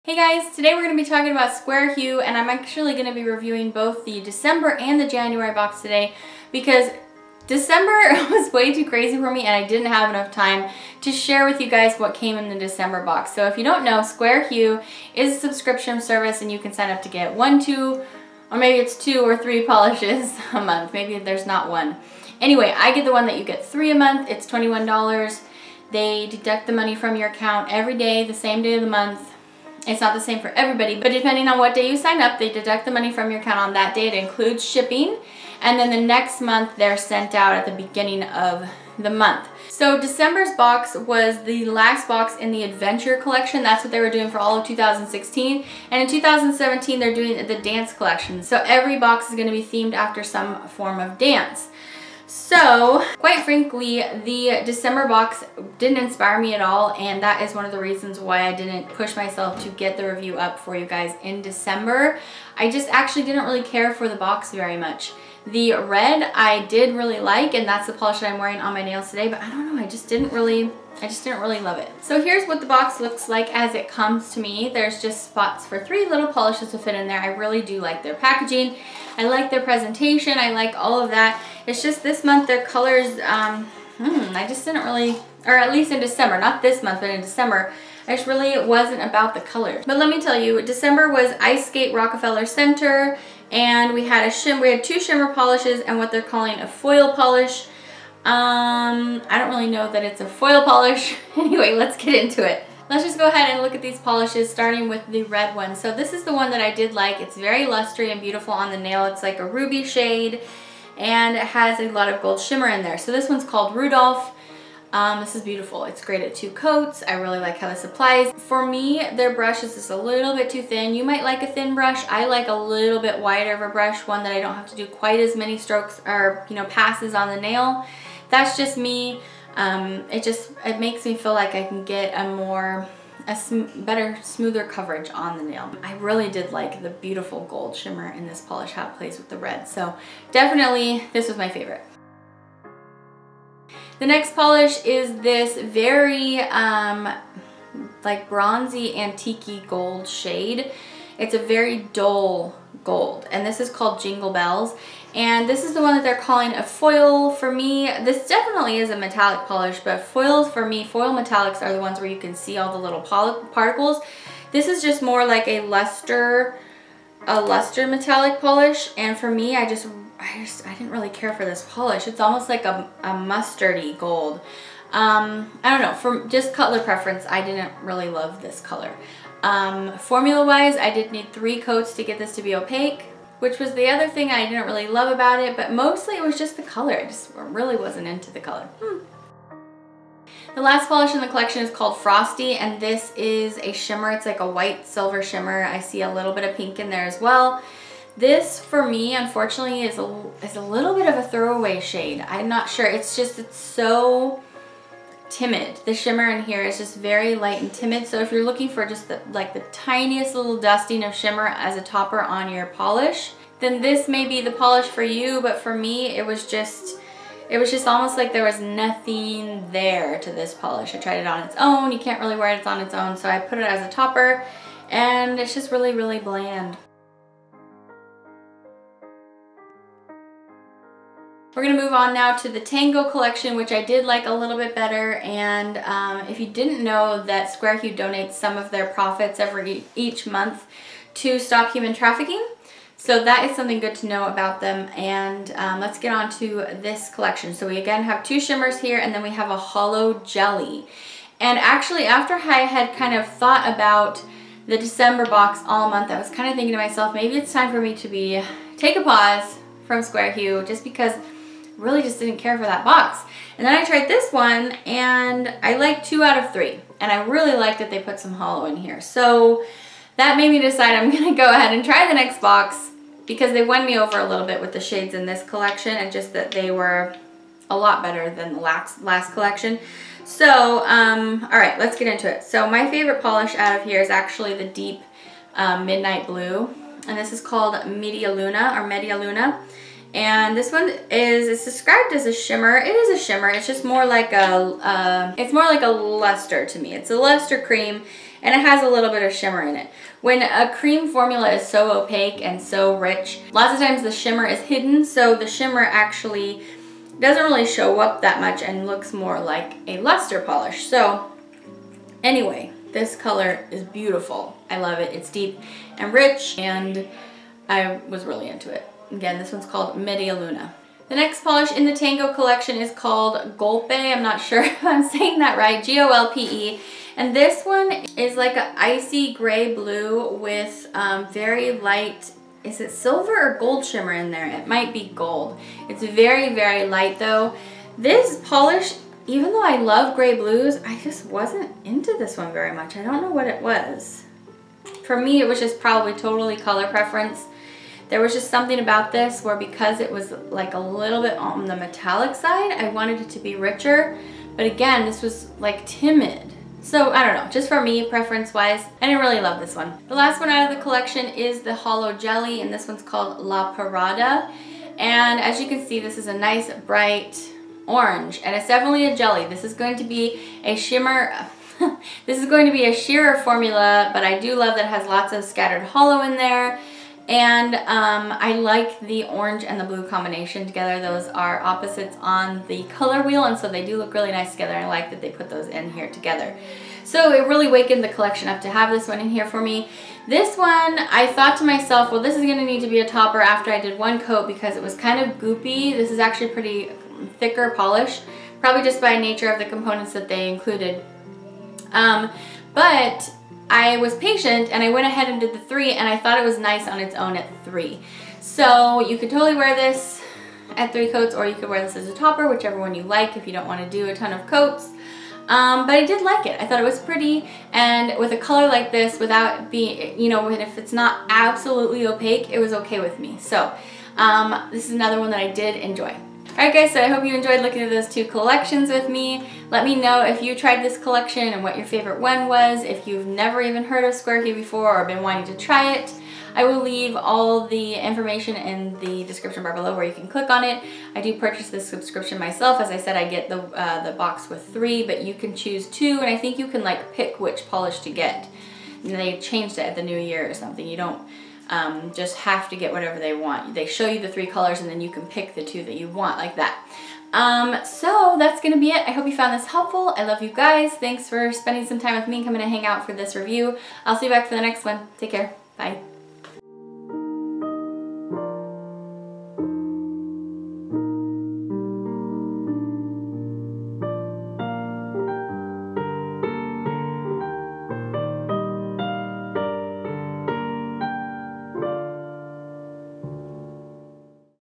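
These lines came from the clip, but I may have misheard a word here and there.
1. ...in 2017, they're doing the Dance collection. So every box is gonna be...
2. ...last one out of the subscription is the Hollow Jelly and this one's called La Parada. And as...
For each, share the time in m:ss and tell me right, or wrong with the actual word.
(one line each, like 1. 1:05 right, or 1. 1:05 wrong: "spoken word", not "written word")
1. 0:46 right
2. 6:00 wrong: "collection", not "subscription".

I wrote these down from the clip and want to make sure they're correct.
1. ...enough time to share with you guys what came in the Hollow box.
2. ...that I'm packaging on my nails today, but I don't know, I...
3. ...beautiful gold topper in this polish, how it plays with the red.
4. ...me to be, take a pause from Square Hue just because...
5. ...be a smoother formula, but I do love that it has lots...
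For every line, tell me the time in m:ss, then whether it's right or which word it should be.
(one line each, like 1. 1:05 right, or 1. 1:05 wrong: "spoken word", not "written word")
1. 0:10 wrong: "December", not "Hollow"
2. 1:08 wrong: "wearing", not "packaging"
3. 2:16 wrong: "shimmer", not "topper"
4. 4:17 right
5. 6:12 wrong: "sheerer", not "smoother".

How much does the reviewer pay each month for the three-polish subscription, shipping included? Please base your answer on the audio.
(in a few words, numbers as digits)
$21.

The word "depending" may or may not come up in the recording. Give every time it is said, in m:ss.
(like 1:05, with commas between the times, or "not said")
0:31.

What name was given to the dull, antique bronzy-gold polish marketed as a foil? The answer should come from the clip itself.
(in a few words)
Jingle Bells.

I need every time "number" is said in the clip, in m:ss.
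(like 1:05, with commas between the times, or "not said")
not said.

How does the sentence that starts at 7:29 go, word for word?
And they changed it at the new year or something.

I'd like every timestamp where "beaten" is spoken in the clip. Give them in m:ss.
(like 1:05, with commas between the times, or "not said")
not said.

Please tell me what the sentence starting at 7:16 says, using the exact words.
I will leave all the information in the description bar below where you can click on it.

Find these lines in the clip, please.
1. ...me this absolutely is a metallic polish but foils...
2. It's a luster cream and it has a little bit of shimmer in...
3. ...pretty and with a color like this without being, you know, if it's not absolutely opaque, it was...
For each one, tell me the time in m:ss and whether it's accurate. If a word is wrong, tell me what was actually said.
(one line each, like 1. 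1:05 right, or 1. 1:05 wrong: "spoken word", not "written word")
1. 2:37 wrong: "definitely", not "absolutely"
2. 4:56 right
3. 6:56 right.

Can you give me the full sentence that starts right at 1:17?
I really do like their packaging.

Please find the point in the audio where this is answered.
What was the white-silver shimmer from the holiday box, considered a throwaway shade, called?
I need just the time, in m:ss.
3:11.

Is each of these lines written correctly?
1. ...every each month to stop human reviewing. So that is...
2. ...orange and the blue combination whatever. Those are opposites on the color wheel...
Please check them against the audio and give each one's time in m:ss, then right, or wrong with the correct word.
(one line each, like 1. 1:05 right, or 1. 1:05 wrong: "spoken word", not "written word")
1. 3:59 wrong: "trafficking", not "reviewing"
2. 6:19 wrong: "together", not "whatever".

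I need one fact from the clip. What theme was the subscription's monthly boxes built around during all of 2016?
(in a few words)
Adventure.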